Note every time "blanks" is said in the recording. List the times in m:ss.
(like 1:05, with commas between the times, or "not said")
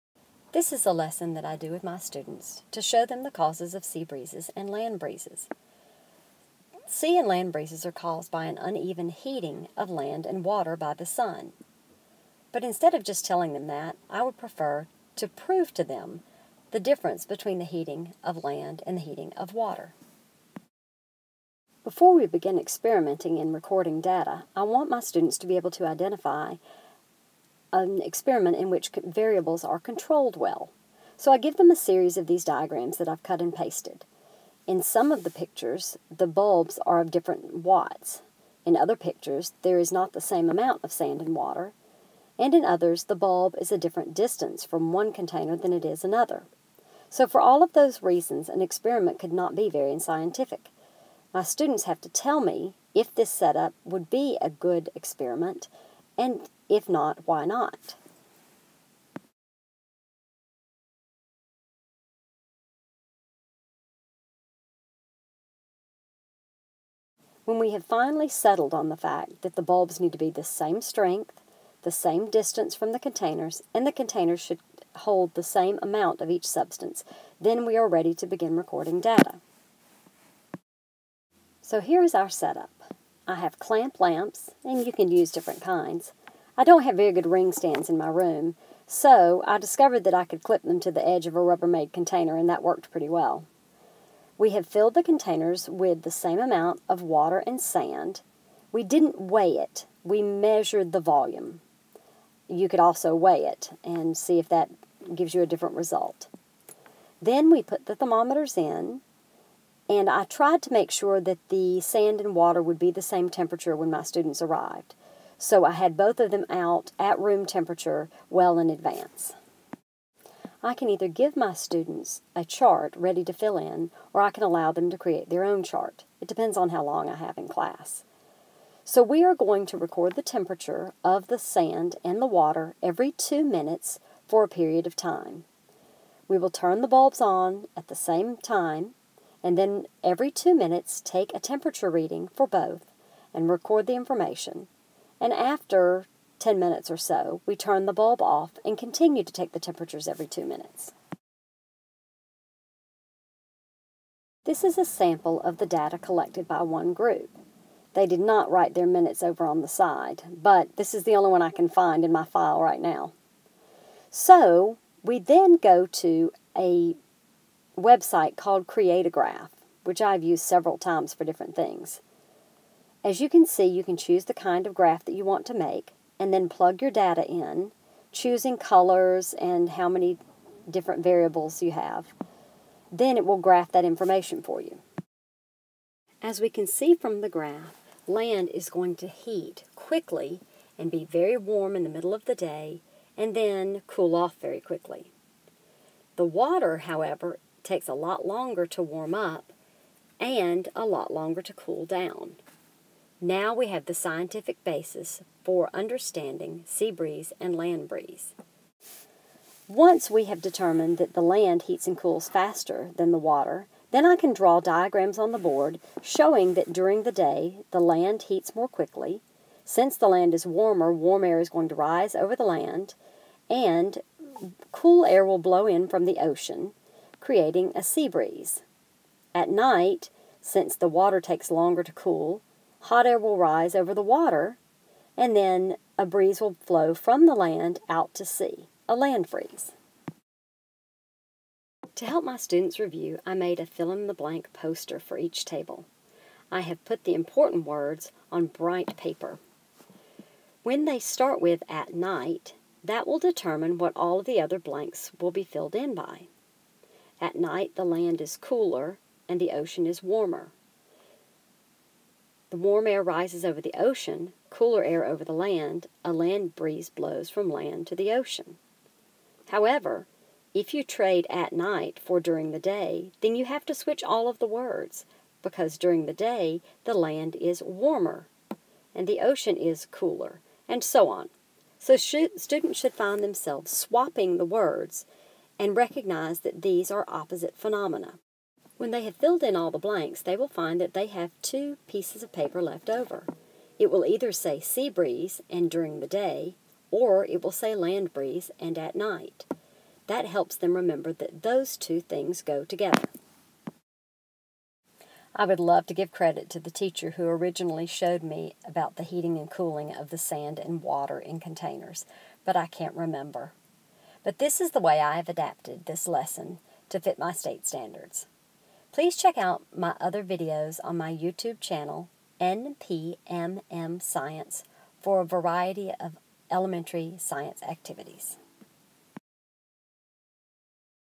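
4:04, 4:14, 4:49.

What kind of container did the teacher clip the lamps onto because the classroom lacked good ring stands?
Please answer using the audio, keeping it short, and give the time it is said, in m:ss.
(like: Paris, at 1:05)
Rubbermaid container, at 1:31.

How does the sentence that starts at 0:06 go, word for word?
Sea and land breezes are caused by an uneven heating of land and water by the sun.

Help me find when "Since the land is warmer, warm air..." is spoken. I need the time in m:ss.
3:39.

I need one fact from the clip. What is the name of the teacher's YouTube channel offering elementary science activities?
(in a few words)
NPMM Science.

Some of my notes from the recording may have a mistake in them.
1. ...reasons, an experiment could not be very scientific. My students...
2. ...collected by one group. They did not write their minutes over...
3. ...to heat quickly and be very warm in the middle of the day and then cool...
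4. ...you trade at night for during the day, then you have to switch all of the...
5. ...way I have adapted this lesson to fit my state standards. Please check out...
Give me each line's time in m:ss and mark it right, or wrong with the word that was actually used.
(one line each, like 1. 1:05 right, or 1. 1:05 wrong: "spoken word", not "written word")
1. 0:48 right
2. 2:35 right
3. 3:08 right
4. 4:30 right
5. 5:14 right.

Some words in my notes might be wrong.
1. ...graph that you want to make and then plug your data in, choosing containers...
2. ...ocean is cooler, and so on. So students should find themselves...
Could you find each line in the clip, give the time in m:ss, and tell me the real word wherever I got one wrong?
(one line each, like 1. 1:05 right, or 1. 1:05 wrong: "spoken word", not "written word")
1. 2:54 wrong: "colors", not "containers"
2. 4:39 right.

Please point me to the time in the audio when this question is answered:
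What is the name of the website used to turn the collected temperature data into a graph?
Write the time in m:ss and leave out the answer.
2:48.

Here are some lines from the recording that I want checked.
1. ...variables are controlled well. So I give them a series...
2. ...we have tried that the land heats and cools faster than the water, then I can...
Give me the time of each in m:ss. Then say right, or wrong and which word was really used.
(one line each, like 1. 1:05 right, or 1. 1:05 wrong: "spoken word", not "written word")
1. 0:29 right
2. 3:30 wrong: "determined", not "tried".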